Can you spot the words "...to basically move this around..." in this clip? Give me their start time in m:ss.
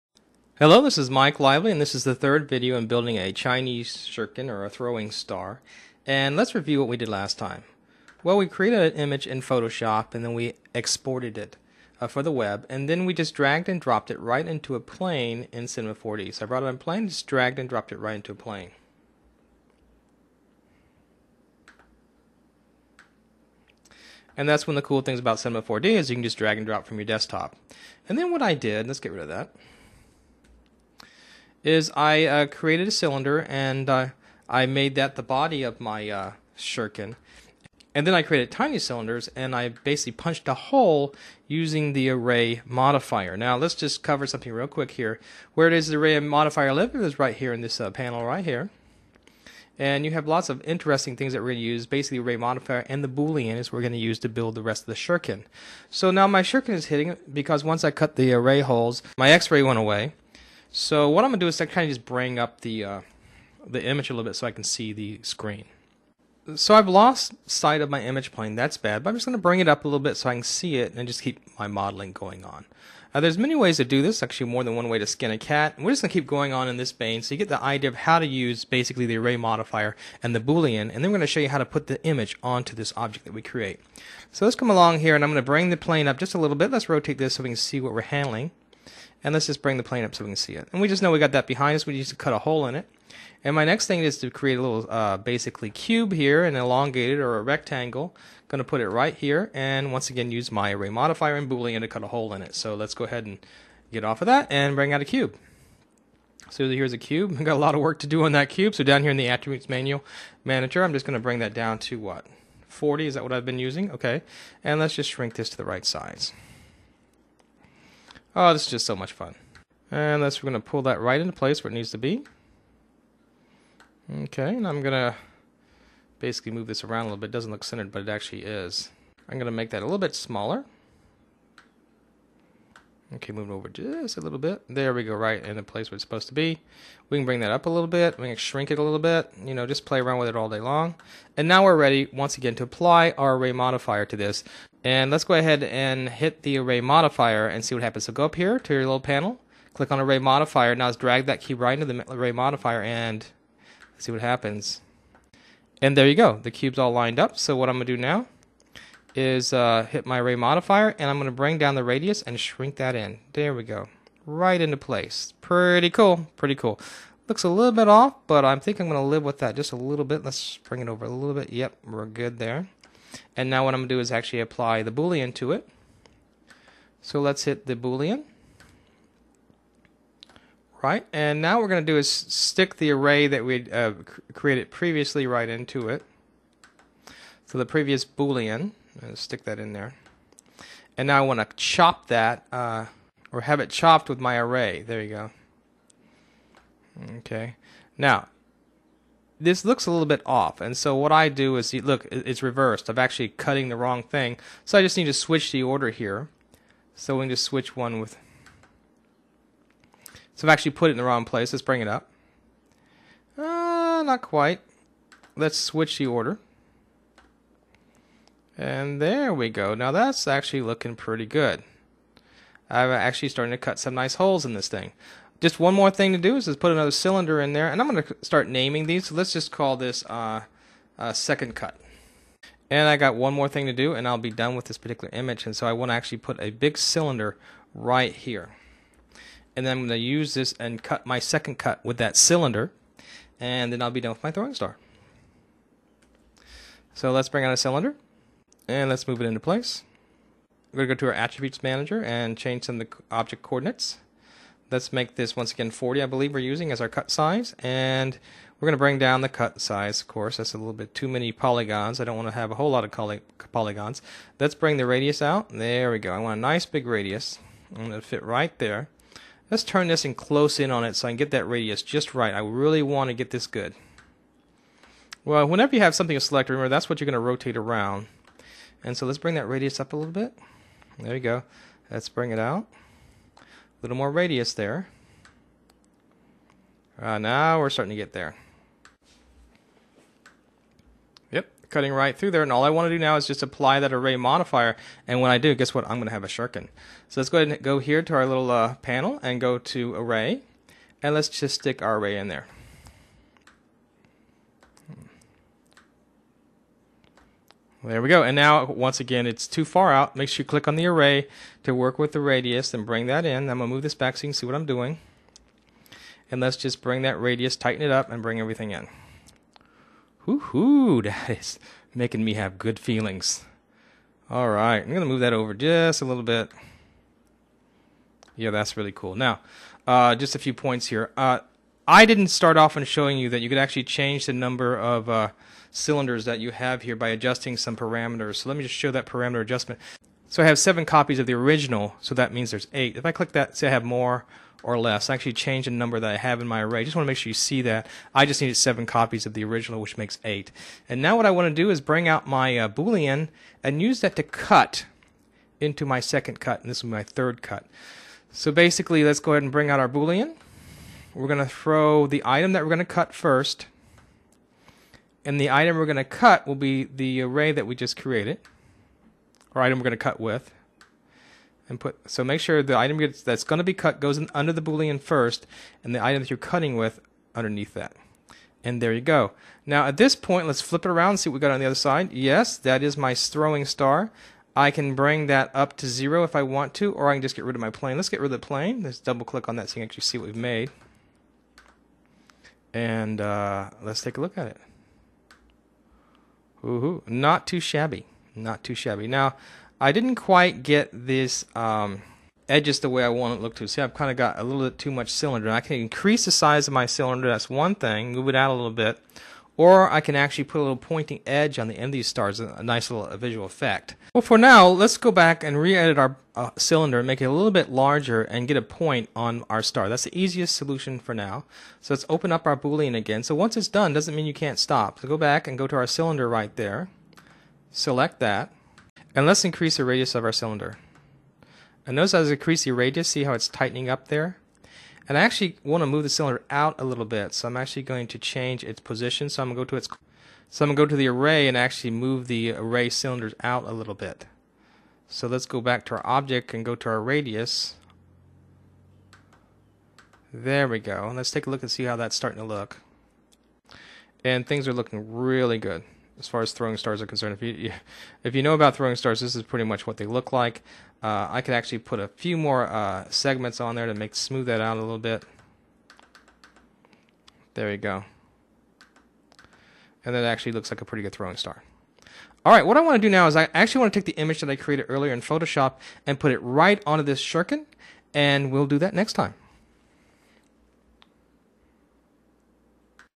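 2:04.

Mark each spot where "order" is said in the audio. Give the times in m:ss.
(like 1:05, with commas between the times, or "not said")
3:25, 3:36.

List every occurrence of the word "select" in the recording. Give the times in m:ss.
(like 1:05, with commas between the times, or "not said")
4:36, 7:07.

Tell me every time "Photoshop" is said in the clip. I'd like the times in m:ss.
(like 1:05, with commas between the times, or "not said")
0:09, 7:55.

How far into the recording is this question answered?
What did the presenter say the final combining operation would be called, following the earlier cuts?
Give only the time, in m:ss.
5:57.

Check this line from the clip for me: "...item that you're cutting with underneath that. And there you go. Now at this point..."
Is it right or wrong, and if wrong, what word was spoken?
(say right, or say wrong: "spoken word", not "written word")
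right.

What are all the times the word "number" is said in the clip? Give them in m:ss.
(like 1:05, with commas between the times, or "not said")
5:34, 5:45.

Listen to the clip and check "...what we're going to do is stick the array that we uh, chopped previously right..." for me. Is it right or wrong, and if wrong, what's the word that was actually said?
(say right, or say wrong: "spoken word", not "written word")
wrong: "created", not "chopped".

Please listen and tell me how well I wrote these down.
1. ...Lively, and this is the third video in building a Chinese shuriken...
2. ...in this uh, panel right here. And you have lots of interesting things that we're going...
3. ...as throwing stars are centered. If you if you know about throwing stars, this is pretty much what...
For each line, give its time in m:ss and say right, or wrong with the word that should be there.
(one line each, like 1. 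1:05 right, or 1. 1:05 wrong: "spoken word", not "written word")
1. 0:01 right
2. 0:47 right
3. 7:36 wrong: "concerned", not "centered".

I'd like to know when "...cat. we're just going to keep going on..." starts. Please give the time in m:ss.
1:15.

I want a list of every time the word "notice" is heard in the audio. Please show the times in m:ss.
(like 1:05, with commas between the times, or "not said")
7:11.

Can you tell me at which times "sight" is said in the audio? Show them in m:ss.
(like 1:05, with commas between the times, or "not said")
1:07.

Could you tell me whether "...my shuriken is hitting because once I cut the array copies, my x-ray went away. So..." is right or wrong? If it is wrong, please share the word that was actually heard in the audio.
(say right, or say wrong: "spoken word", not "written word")
wrong: "holes", not "copies".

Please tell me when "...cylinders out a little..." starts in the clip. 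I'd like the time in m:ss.
7:22.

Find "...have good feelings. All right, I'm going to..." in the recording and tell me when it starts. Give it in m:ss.
5:22.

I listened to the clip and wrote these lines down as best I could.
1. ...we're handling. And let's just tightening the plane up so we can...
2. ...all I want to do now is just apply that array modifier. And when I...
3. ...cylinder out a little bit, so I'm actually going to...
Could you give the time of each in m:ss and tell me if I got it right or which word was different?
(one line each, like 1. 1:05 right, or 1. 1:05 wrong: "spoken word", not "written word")
1. 1:27 wrong: "bring", not "tightening"
2. 4:52 right
3. 7:16 right.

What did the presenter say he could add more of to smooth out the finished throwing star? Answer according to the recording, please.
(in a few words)
segments.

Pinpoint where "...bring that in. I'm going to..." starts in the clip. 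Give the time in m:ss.
5:12.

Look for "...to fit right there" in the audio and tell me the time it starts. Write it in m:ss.
4:27.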